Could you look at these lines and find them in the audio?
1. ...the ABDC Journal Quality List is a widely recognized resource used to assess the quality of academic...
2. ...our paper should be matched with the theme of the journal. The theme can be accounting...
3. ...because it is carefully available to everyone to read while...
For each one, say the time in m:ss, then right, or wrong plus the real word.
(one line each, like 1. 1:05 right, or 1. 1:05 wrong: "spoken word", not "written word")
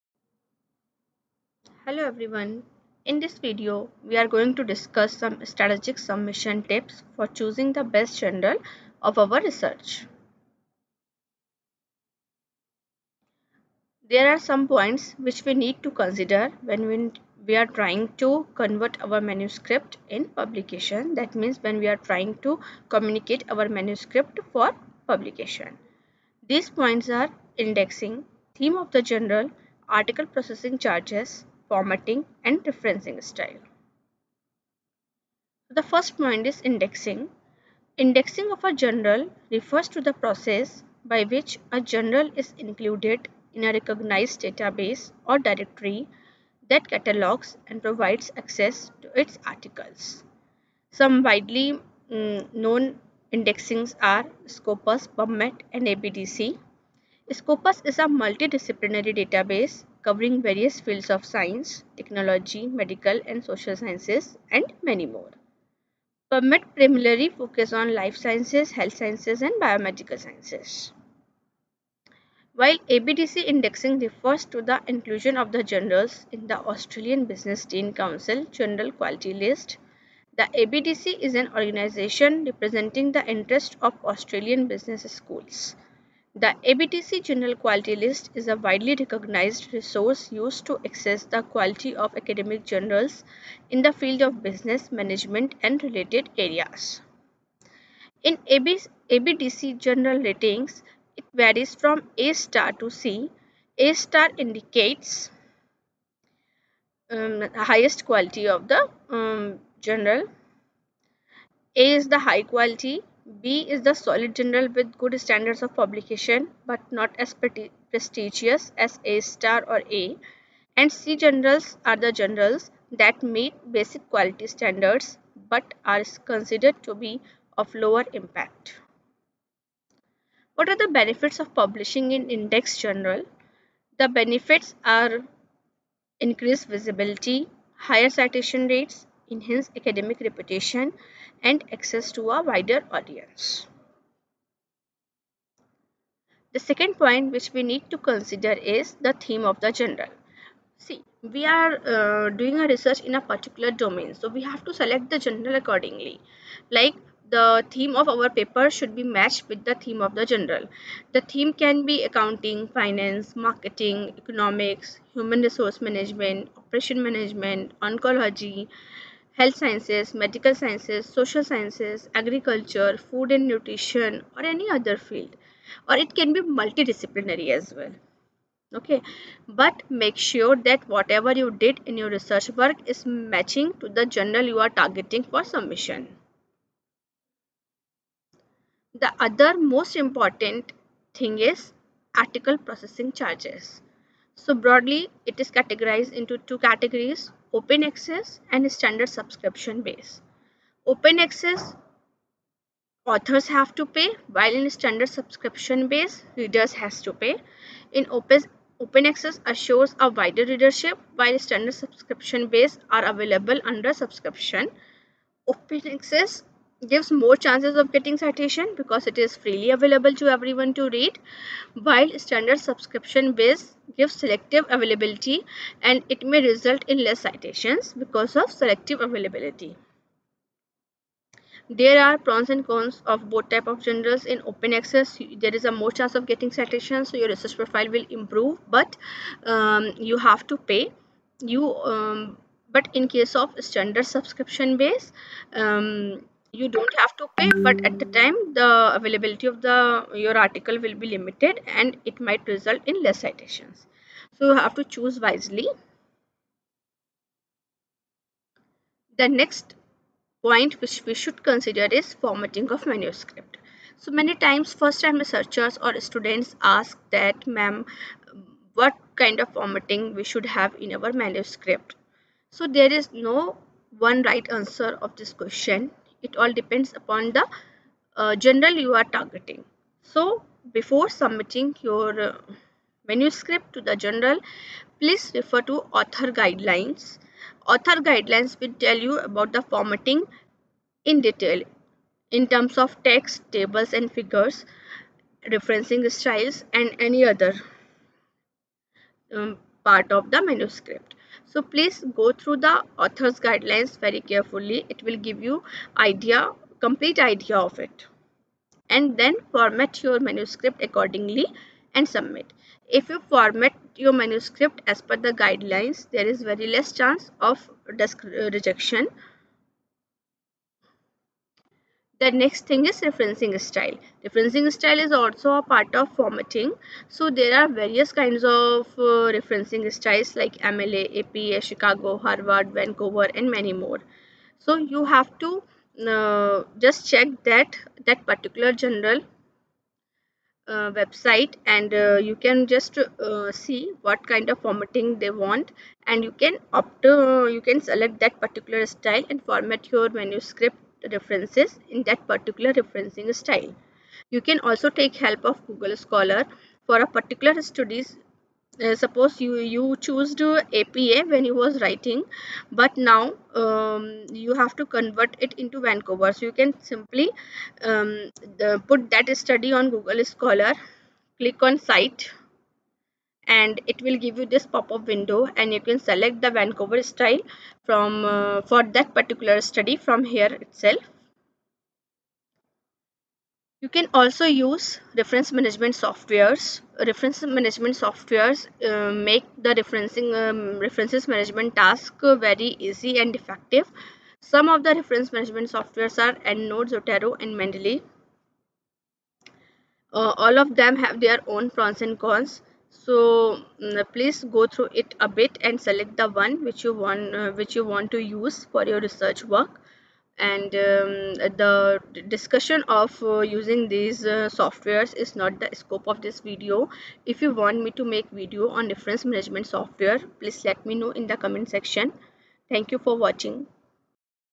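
1. 1:26 right
2. 2:38 right
3. 3:38 wrong: "freely", not "carefully".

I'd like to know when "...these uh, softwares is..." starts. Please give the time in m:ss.
6:53.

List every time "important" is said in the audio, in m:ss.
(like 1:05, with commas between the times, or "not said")
3:09.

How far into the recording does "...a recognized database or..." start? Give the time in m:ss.
0:43.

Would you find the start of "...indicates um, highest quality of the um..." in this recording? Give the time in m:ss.
1:44.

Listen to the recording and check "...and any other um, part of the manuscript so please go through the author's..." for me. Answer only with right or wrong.
right.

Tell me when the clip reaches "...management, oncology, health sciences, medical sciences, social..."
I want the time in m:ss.
2:47.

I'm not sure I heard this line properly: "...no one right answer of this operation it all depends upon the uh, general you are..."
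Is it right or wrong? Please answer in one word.
wrong.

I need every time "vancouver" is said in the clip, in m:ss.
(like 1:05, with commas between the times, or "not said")
5:32, 6:05, 6:16.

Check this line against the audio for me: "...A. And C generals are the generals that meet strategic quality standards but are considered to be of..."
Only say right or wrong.
wrong.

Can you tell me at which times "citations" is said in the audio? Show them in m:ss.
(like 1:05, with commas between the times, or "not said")
2:18, 3:38, 3:47, 3:56, 4:13.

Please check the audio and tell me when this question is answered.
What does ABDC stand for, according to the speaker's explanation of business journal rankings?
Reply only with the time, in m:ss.
1:16.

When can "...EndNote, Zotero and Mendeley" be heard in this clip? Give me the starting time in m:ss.
6:36.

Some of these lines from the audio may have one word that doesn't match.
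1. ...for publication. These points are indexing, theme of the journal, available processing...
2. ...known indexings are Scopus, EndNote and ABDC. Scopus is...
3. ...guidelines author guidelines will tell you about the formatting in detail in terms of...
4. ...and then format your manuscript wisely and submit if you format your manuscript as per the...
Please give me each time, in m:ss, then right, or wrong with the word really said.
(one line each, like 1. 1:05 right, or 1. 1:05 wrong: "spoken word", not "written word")
1. 0:24 wrong: "article", not "available"
2. 0:52 wrong: "PubMed", not "EndNote"
3. 4:46 right
4. 5:08 wrong: "accordingly", not "wisely".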